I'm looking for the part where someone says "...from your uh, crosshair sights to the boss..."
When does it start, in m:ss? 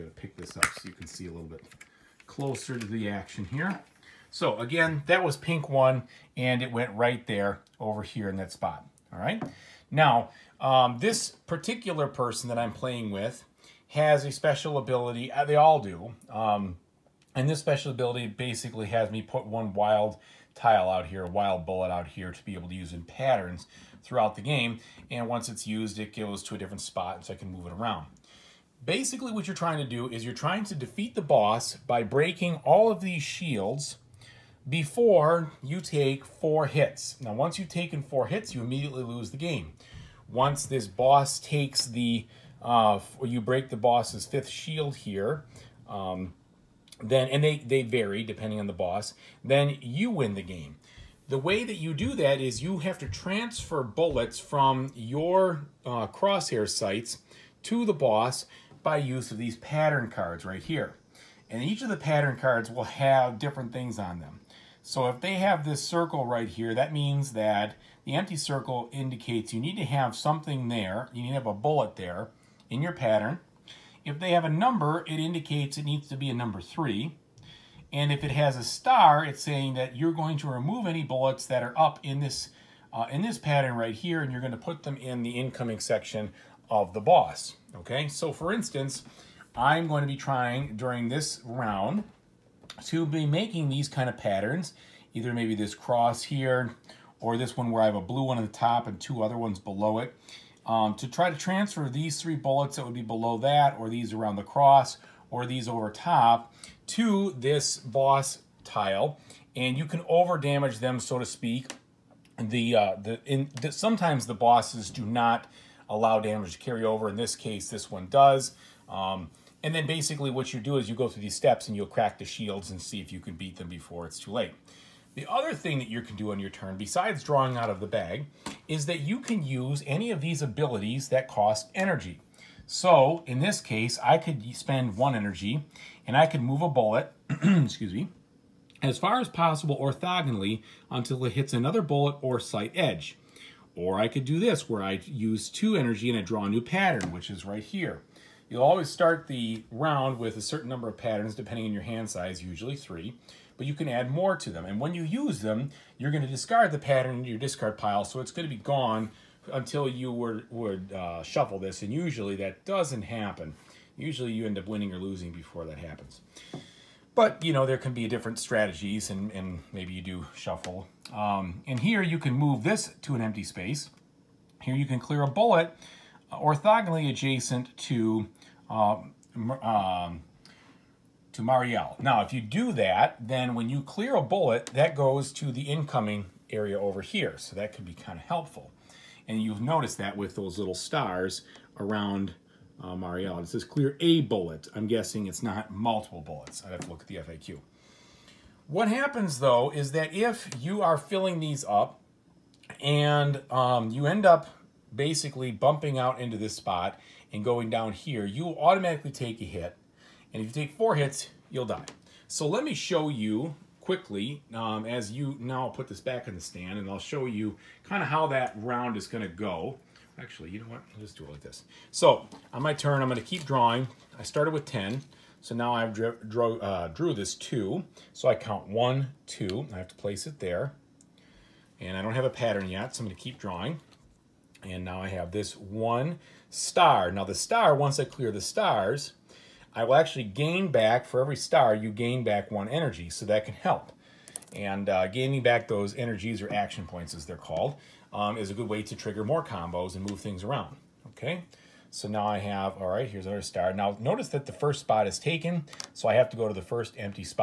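0:54.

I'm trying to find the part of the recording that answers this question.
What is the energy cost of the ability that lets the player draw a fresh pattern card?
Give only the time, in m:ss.
2:25.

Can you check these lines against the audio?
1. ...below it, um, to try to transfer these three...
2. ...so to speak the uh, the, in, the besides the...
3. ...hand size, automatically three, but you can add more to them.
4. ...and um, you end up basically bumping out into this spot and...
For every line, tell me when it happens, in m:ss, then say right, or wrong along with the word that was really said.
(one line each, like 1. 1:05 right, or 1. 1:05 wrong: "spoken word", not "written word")
1. 1:39 right
2. 1:50 wrong: "sometimes", not "besides"
3. 2:31 wrong: "usually", not "automatically"
4. 3:22 right.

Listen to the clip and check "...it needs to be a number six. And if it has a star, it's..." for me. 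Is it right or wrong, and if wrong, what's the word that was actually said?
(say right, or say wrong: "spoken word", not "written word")
wrong: "three", not "six".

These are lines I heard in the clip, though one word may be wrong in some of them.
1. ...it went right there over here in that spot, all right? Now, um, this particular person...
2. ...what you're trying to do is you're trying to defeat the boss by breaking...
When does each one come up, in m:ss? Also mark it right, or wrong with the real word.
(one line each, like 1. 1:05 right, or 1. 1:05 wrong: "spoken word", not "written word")
1. 0:06 right
2. 0:29 right.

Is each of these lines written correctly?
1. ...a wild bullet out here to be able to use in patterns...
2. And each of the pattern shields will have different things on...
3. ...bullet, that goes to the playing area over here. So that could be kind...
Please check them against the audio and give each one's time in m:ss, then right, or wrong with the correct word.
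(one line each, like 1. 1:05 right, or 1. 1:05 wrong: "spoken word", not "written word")
1. 0:21 right
2. 1:01 wrong: "cards", not "shields"
3. 3:04 wrong: "incoming", not "playing".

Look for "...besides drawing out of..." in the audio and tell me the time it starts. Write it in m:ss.
2:06.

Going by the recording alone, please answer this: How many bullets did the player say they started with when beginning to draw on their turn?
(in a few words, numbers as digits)
10.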